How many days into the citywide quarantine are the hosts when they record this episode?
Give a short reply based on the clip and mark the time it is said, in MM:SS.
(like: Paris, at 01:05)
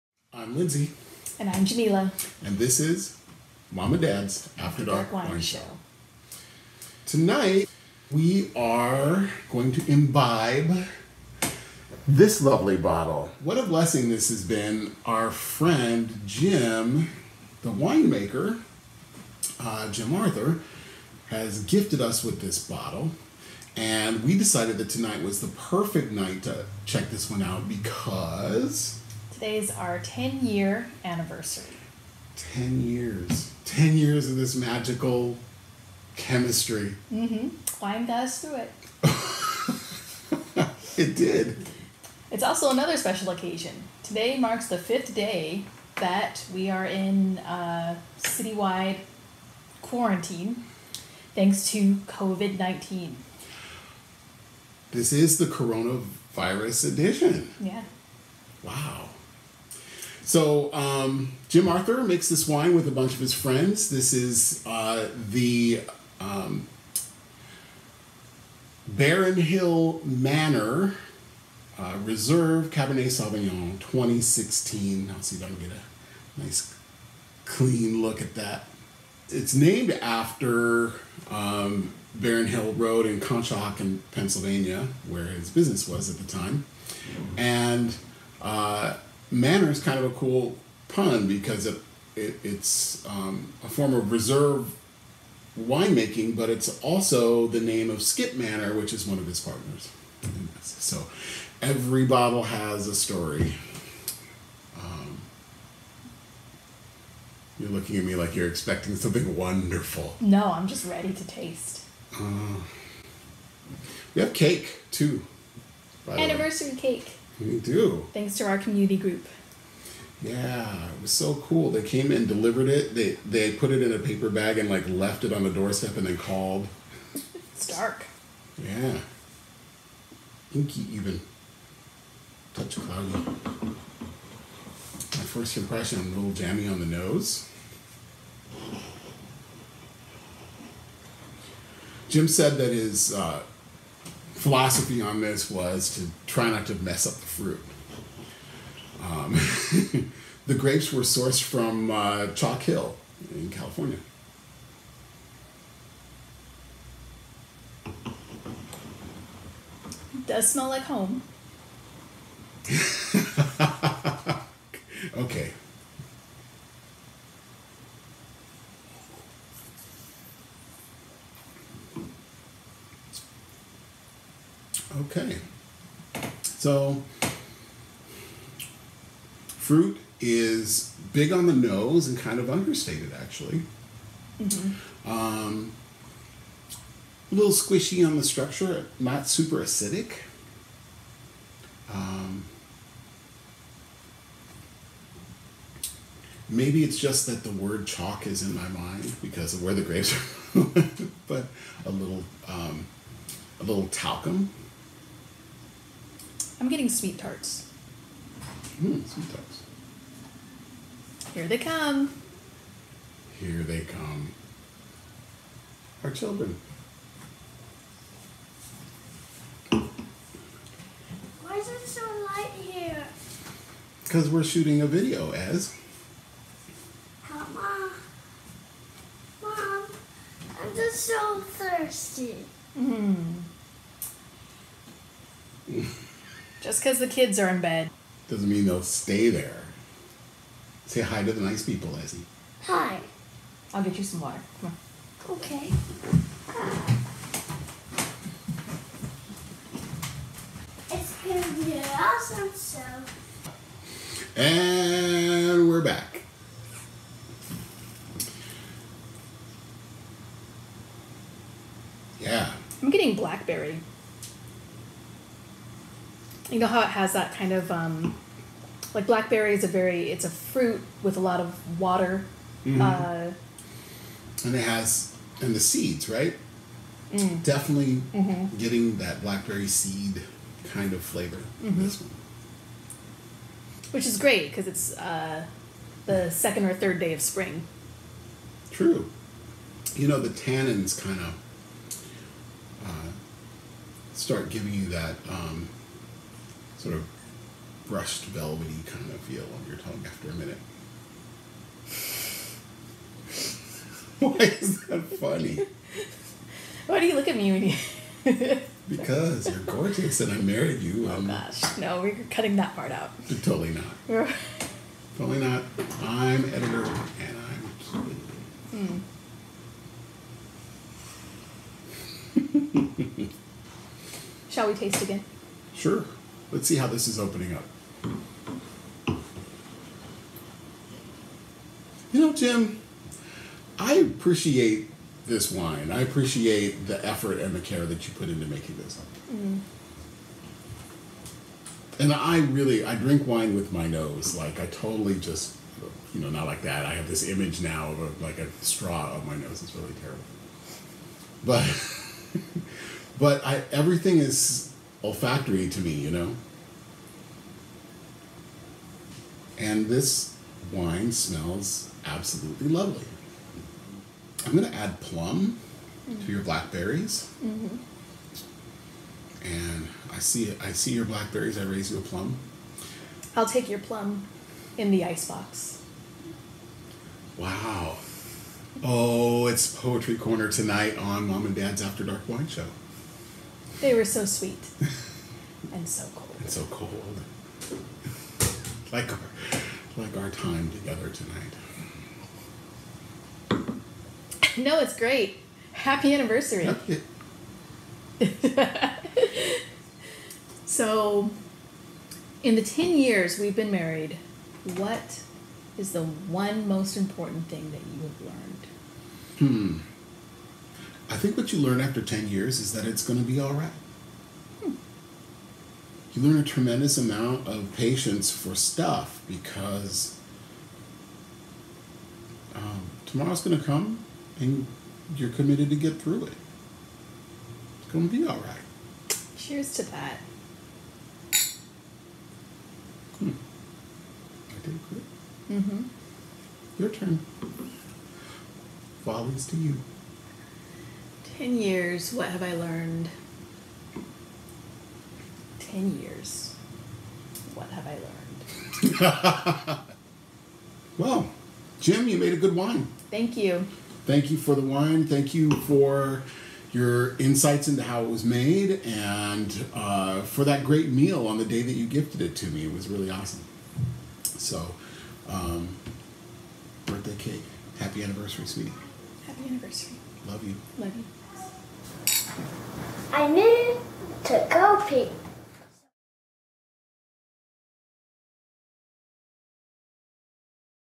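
5, at 00:44.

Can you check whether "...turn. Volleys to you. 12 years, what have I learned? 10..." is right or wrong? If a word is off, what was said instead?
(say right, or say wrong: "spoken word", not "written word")
wrong: "10", not "12".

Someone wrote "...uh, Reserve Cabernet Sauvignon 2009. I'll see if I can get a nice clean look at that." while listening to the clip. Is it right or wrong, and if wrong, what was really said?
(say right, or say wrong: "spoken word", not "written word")
wrong: "2016", not "2009".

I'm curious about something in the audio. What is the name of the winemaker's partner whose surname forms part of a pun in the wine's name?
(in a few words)
Skip Maner.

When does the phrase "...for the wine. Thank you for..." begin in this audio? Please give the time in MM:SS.
07:34.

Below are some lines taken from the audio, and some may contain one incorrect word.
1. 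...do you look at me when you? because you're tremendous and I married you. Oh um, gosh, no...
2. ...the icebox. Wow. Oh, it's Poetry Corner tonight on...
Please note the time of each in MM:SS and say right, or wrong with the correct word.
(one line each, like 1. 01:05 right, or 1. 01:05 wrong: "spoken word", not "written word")
1. 05:06 wrong: "gorgeous", not "tremendous"
2. 06:14 right.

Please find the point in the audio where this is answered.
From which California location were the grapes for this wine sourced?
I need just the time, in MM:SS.
02:32.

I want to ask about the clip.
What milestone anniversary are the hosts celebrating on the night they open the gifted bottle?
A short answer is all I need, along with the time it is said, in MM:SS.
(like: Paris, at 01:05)
10 year, at 00:29.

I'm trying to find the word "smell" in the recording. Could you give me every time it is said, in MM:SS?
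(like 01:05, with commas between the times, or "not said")
02:40, 06:01.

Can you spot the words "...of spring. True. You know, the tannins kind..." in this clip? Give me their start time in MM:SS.
04:47.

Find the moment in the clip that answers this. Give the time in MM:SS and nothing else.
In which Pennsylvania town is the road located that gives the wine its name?
01:23.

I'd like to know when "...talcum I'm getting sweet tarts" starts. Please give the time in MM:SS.
03:23.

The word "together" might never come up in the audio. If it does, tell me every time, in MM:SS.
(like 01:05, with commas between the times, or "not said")
06:30.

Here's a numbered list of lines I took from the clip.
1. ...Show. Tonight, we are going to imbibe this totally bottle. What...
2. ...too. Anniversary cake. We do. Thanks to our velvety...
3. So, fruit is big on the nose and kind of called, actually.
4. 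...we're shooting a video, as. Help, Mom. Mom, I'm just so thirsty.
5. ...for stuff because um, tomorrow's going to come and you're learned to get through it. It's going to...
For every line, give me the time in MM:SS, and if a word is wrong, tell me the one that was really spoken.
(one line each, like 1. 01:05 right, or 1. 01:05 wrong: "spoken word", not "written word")
1. 00:05 wrong: "lovely", not "totally"
2. 01:54 wrong: "community", not "velvety"
3. 02:56 wrong: "understated", not "called"
4. 03:44 right
5. 06:58 wrong: "committed", not "learned".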